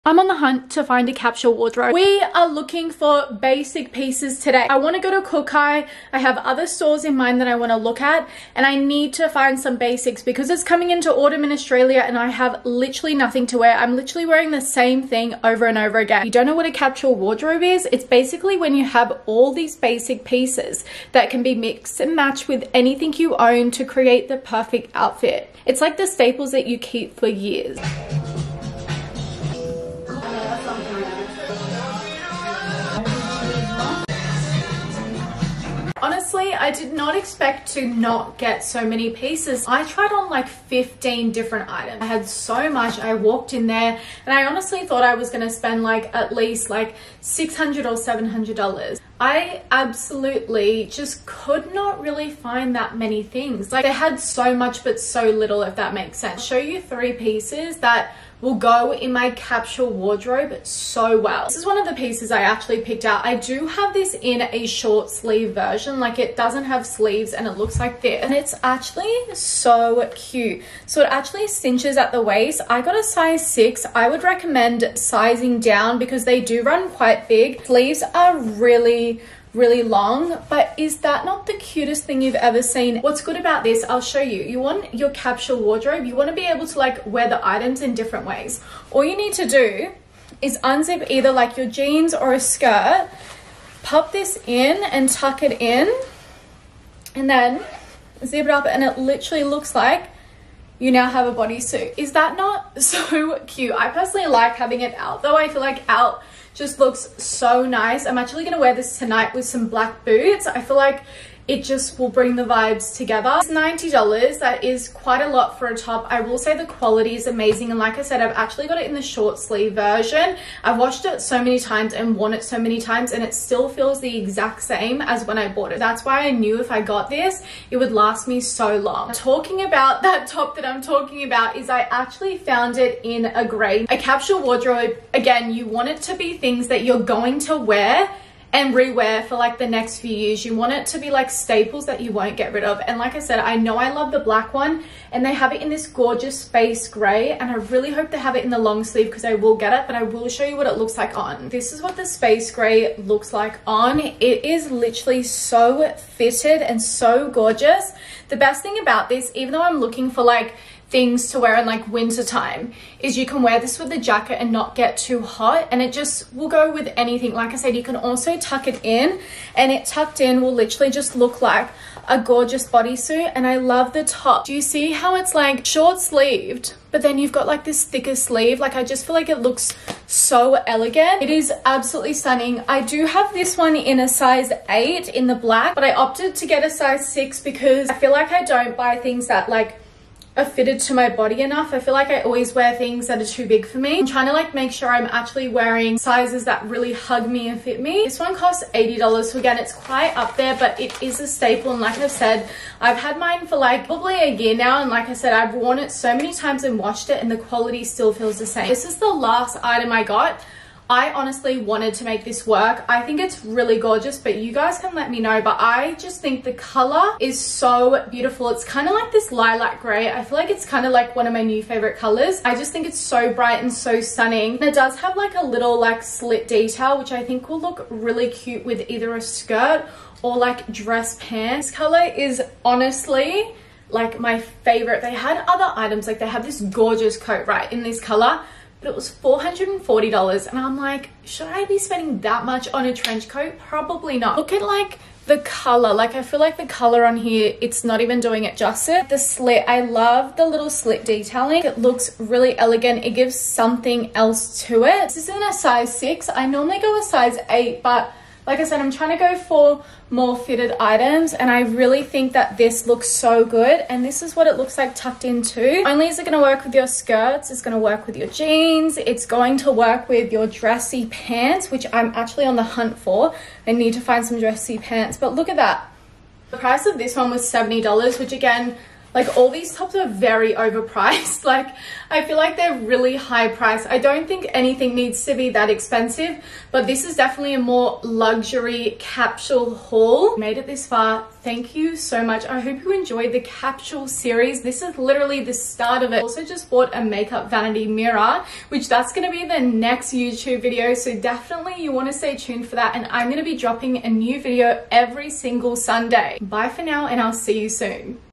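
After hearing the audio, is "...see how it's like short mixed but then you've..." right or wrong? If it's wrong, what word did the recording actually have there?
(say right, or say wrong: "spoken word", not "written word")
wrong: "sleeved", not "mixed".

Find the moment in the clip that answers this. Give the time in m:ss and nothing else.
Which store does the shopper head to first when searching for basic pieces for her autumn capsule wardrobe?
0:05.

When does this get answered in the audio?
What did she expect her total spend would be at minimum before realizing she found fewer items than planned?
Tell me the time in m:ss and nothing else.
0:47.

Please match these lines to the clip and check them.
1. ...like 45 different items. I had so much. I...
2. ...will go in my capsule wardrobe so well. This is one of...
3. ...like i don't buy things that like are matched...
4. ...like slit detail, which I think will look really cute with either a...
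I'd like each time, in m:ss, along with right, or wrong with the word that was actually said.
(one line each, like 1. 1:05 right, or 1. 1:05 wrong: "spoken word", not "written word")
1. 0:40 wrong: "15", not "45"
2. 0:58 right
3. 3:08 wrong: "fitted", not "matched"
4. 3:45 right.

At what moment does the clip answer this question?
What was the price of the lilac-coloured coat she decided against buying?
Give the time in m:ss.
3:59.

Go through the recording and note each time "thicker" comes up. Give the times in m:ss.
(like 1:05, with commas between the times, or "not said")
2:57.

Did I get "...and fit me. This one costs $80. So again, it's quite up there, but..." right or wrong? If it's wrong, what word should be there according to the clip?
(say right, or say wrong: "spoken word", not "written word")
right.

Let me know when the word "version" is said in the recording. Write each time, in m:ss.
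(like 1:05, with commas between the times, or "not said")
1:05, 1:59.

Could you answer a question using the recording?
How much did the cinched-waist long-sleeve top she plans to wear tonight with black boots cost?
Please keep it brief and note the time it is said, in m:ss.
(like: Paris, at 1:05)
$90, at 1:53.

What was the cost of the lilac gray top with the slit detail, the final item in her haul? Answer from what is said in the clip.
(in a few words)
$70.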